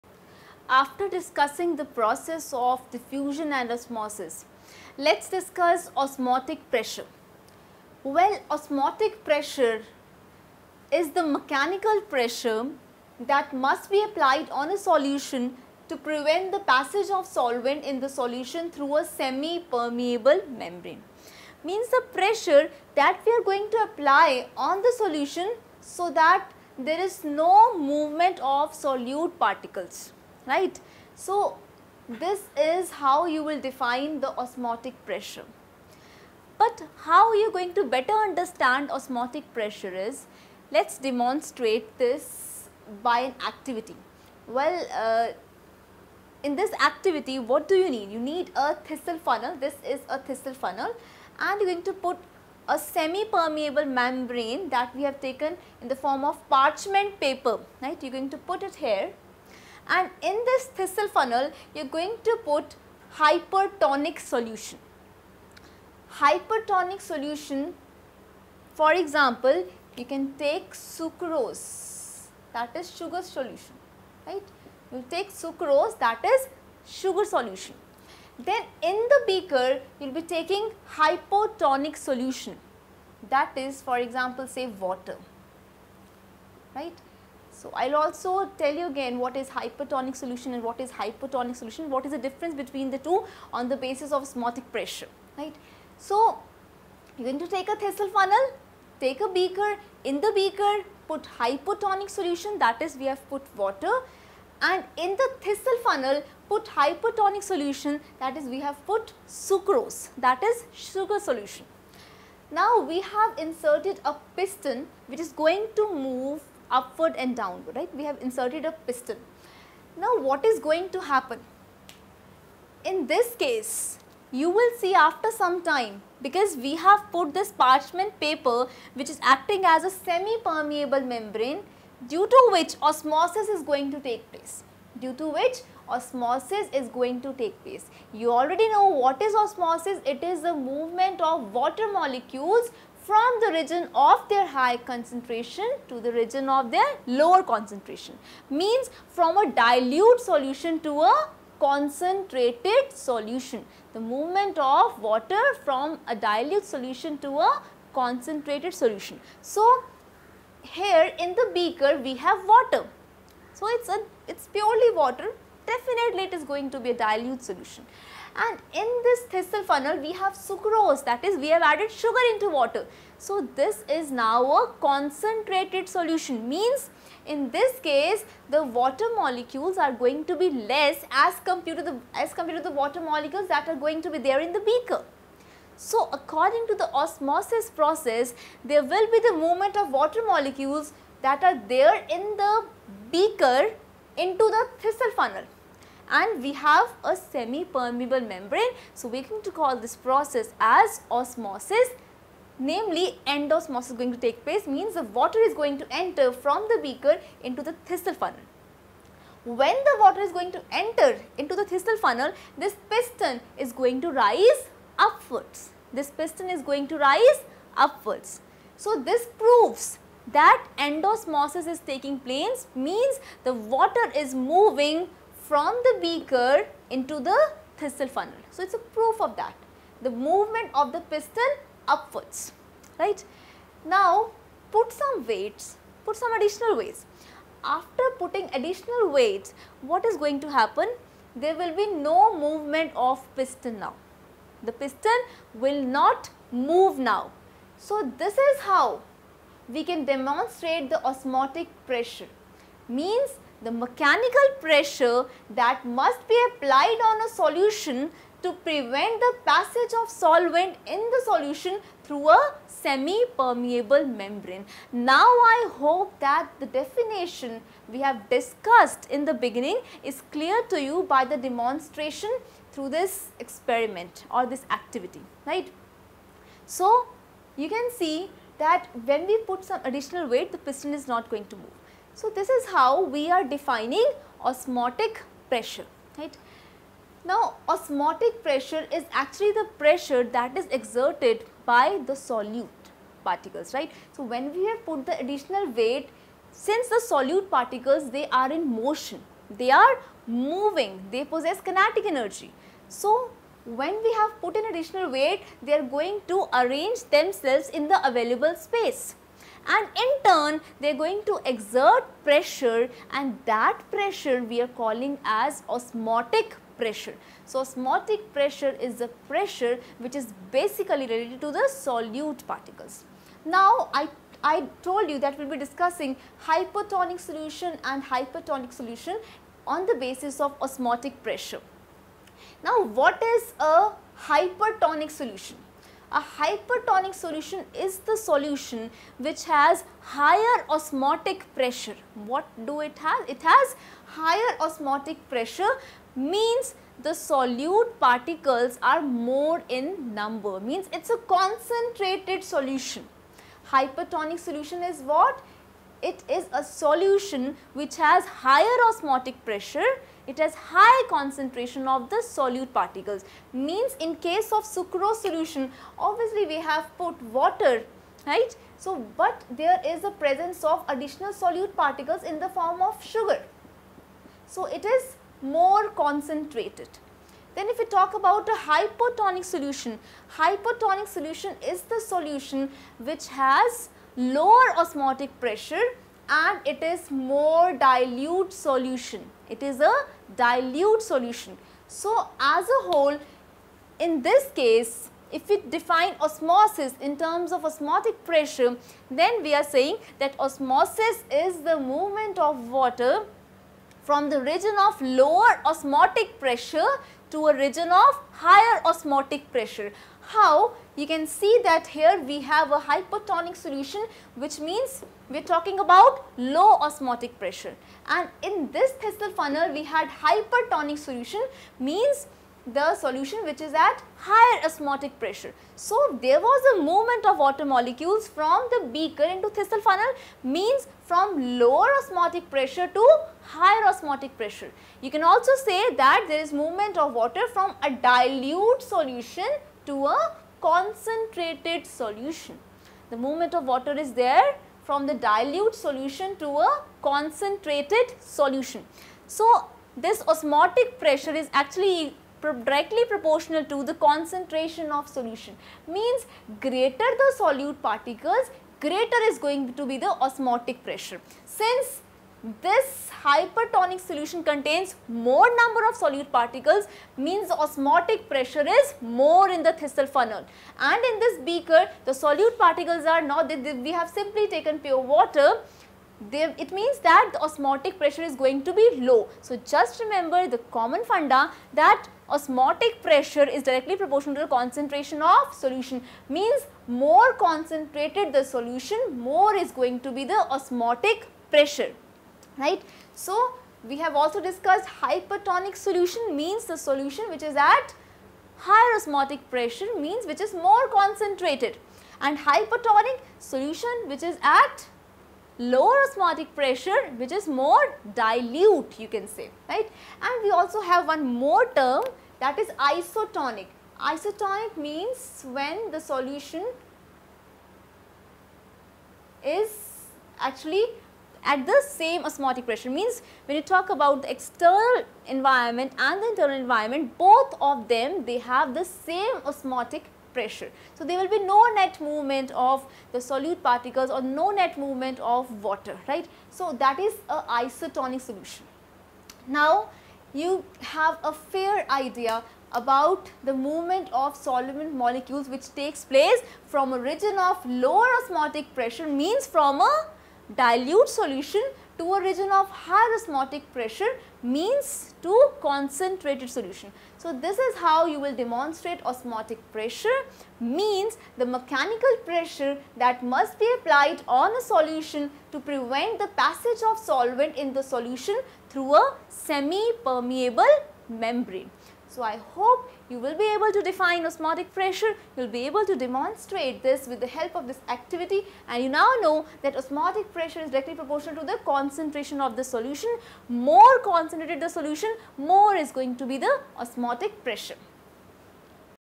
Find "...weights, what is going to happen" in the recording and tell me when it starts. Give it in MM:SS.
03:59.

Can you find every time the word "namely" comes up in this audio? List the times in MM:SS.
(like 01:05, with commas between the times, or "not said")
03:22.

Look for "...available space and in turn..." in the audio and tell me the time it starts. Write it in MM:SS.
05:08.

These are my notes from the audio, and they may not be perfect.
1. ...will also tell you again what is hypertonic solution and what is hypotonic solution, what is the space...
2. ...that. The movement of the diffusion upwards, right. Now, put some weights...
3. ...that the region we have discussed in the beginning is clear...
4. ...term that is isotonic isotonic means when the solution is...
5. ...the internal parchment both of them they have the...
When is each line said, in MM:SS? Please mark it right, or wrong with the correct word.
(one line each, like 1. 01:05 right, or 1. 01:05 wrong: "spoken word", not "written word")
1. 01:27 wrong: "difference", not "space"
2. 03:49 wrong: "piston", not "diffusion"
3. 04:26 wrong: "definition", not "region"
4. 08:31 right
5. 08:46 wrong: "environment", not "parchment".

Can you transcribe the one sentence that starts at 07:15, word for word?
You can also say that there is movement of water from a dilute solution to a concentrated solution.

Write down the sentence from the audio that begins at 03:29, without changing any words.
When the water is going to enter into the thistle funnel, this piston is going to rise upwards.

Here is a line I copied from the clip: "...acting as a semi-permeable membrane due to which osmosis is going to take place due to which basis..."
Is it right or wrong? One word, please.
wrong.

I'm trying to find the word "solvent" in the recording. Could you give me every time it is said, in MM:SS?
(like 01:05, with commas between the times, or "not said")
00:17, 04:20, 09:04, 09:26.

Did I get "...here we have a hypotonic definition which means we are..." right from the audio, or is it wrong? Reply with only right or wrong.
wrong.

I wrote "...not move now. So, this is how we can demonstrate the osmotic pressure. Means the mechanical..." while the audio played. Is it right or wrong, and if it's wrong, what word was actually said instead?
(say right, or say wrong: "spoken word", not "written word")
right.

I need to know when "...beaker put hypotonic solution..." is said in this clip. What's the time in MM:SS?
01:40.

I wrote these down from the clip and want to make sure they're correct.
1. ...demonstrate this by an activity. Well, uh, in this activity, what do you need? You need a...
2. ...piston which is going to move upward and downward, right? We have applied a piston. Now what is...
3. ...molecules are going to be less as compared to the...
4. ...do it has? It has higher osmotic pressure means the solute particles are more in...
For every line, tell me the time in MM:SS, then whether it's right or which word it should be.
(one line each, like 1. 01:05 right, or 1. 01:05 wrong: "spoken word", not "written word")
1. 00:40 right
2. 01:54 wrong: "inserted", not "applied"
3. 02:59 right
4. 05:42 right.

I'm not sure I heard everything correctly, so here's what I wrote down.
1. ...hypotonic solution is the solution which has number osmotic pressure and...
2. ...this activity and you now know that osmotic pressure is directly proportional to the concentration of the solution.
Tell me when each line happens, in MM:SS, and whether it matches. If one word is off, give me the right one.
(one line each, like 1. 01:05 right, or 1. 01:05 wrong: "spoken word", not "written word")
1. 06:20 wrong: "lower", not "number"
2. 09:37 right.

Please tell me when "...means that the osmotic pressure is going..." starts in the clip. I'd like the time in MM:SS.
07:56.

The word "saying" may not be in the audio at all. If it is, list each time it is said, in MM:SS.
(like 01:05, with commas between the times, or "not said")
06:39.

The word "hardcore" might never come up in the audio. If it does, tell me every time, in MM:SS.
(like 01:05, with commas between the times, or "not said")
not said.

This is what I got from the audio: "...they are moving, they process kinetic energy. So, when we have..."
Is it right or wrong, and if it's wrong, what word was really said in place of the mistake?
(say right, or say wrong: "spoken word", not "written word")
wrong: "possess", not "process".